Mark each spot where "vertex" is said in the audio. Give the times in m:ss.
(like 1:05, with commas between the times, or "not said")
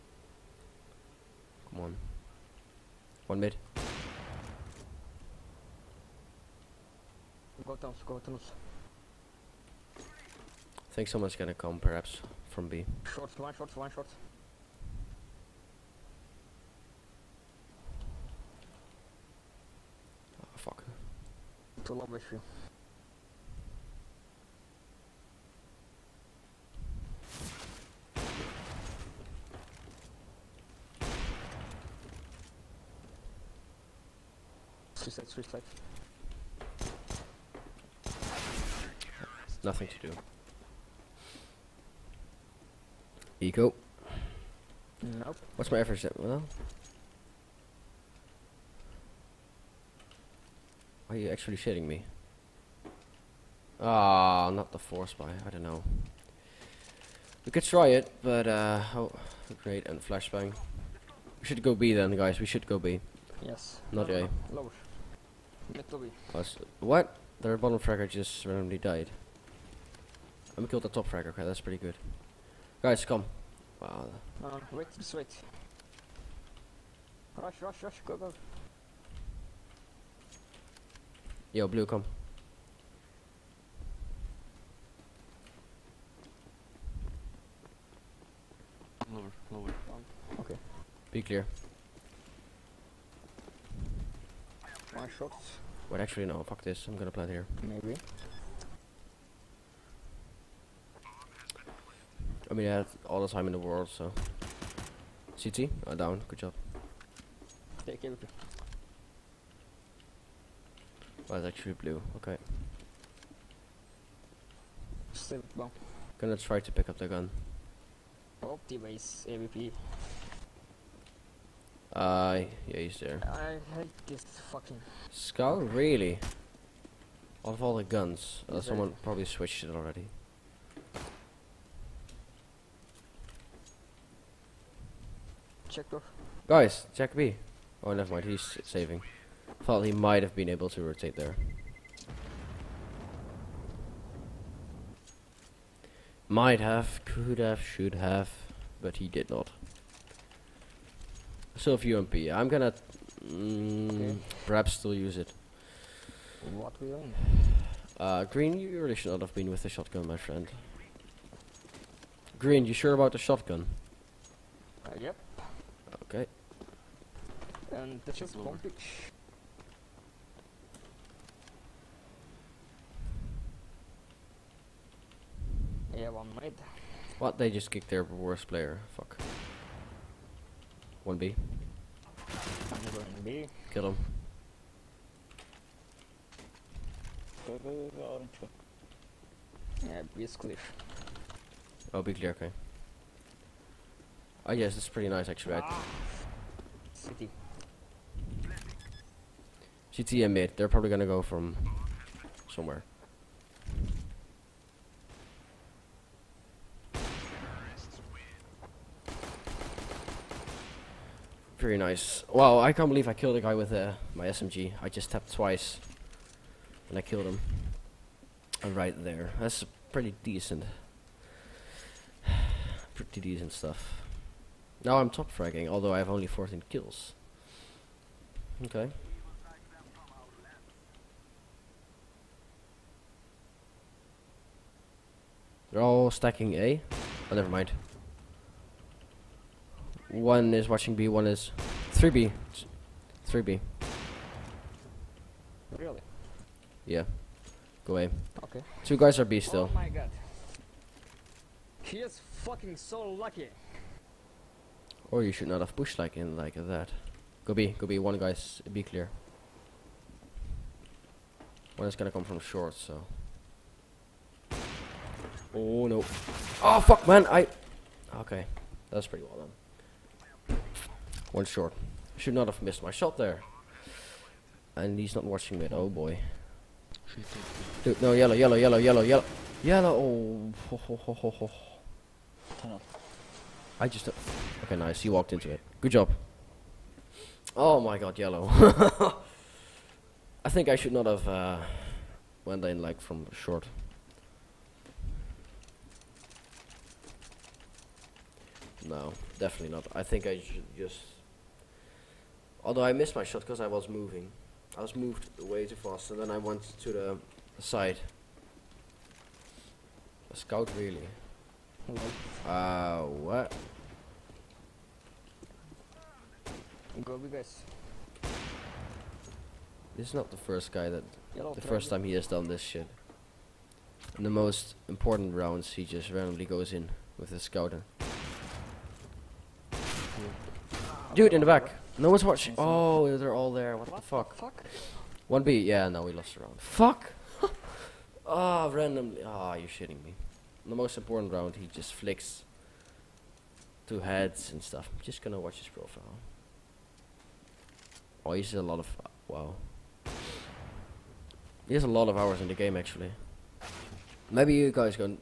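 not said.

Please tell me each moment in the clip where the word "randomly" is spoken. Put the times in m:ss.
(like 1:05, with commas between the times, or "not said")
1:08, 5:26, 5:38.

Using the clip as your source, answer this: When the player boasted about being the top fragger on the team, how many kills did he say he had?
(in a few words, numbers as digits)
14.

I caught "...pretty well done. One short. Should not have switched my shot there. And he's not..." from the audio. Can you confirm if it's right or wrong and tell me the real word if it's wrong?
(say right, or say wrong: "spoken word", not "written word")
wrong: "missed", not "switched".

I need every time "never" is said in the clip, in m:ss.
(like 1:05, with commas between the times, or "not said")
2:17, 3:57.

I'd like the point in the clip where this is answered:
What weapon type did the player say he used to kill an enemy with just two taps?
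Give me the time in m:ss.
3:34.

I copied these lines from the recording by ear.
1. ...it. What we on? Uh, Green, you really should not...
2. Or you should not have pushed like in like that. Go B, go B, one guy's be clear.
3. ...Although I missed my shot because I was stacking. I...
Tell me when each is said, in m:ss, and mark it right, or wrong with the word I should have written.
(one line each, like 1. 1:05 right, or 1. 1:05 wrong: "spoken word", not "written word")
1. 2:35 right
2. 4:15 right
3. 5:02 wrong: "moving", not "stacking".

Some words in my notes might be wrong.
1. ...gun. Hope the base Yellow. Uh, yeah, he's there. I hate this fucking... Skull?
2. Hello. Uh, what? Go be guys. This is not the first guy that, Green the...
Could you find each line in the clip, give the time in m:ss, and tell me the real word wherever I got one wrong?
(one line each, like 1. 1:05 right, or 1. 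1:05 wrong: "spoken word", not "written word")
1. 1:57 wrong: "AVP", not "Yellow"
2. 5:11 wrong: "Yellow", not "Green".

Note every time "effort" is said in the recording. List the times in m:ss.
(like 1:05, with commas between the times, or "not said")
0:45.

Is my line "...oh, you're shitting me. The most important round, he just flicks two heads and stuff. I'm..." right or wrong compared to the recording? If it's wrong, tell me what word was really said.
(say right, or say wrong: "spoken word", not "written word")
right.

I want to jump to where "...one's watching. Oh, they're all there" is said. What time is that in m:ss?
5:32.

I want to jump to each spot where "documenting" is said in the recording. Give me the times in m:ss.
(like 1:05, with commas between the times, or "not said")
not said.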